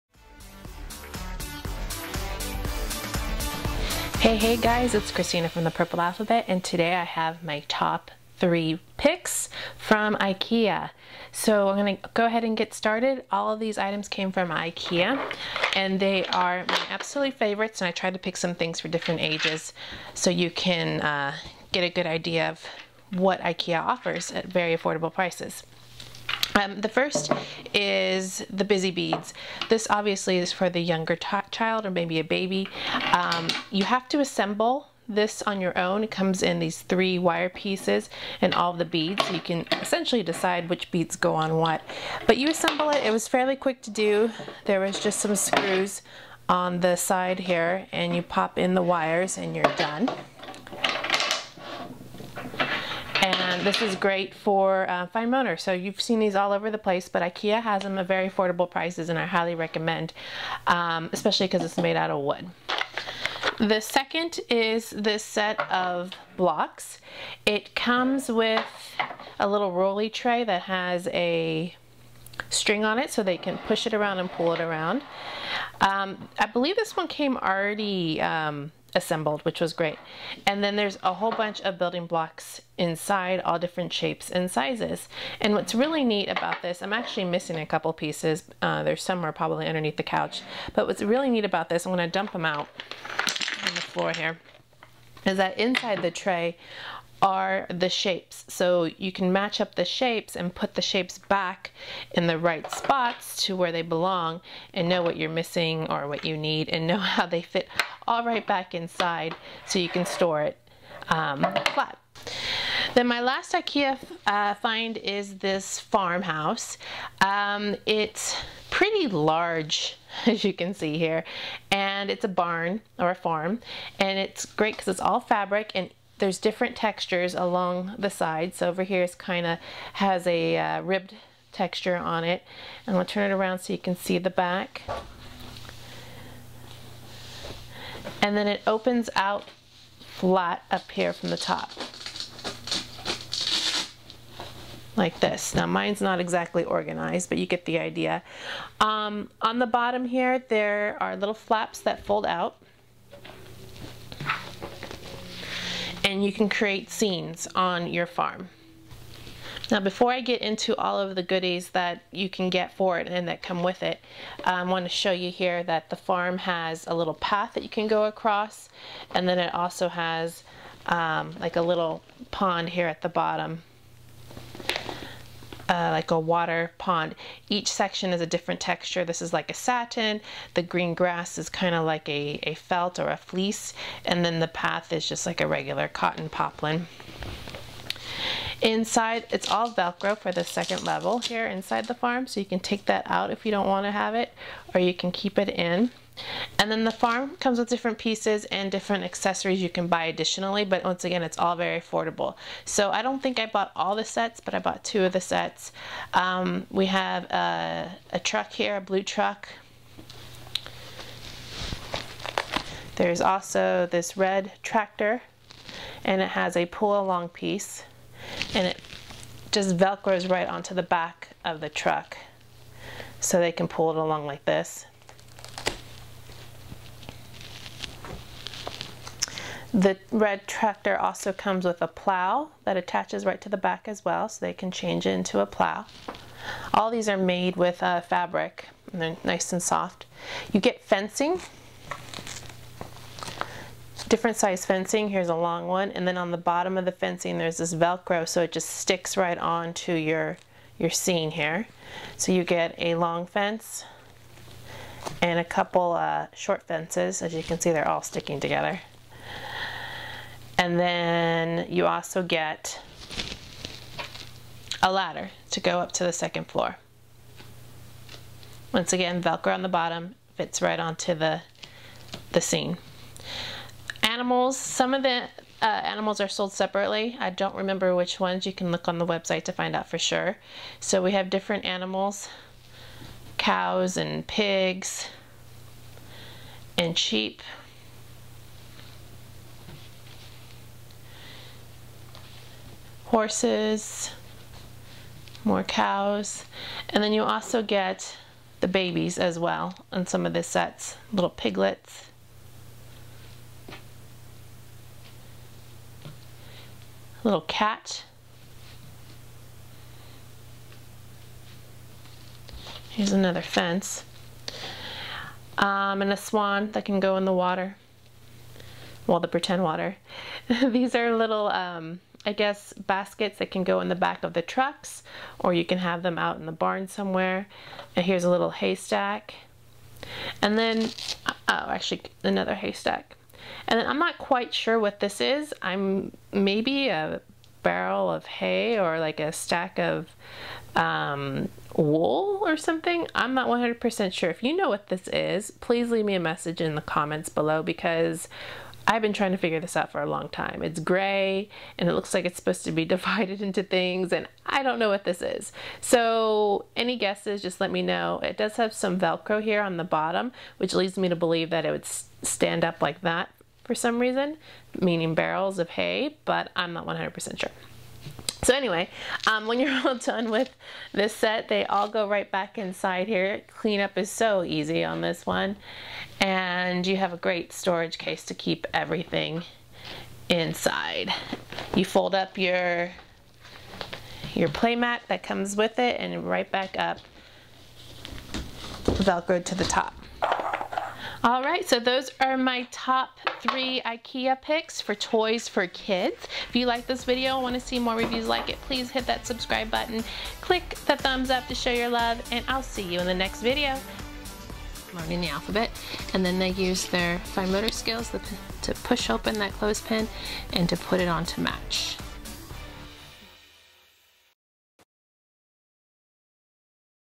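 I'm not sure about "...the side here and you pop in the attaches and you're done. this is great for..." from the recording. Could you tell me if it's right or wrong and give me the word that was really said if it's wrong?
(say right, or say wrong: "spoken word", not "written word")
wrong: "wires", not "attaches".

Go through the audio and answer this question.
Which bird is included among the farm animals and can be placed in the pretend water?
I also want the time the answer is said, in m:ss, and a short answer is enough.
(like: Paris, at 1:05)
swan, at 5:16.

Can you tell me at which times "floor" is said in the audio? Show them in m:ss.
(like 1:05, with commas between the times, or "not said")
1:33, 4:26.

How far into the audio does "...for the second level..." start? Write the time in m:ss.
3:10.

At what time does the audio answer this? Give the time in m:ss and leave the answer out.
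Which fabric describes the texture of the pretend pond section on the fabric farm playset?
2:59.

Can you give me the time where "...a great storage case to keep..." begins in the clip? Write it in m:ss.
6:17.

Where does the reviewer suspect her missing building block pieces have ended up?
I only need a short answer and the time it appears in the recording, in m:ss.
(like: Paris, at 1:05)
underneath the couch, at 1:29.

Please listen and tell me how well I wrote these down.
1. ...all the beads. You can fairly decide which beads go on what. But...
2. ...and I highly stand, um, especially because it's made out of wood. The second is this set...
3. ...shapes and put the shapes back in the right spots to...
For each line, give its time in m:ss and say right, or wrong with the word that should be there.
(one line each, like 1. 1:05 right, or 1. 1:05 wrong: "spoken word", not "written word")
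1. 0:38 wrong: "essentially", not "fairly"
2. 0:59 wrong: "recommend", not "stand"
3. 1:39 right.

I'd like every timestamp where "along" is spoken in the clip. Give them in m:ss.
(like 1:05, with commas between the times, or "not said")
2:07, 3:36, 3:43.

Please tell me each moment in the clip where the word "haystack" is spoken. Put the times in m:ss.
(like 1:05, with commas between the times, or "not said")
5:28, 5:32.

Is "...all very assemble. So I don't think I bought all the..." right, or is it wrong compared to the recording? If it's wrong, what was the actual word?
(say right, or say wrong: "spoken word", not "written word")
wrong: "affordable", not "assemble".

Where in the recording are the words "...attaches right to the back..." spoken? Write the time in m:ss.
3:52.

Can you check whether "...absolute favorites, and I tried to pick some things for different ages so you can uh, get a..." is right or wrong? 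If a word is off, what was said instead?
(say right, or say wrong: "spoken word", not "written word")
right.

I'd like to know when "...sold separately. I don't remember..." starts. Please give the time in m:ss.
4:36.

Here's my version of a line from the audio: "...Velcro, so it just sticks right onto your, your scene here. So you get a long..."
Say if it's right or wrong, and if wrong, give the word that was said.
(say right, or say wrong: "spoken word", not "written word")
right.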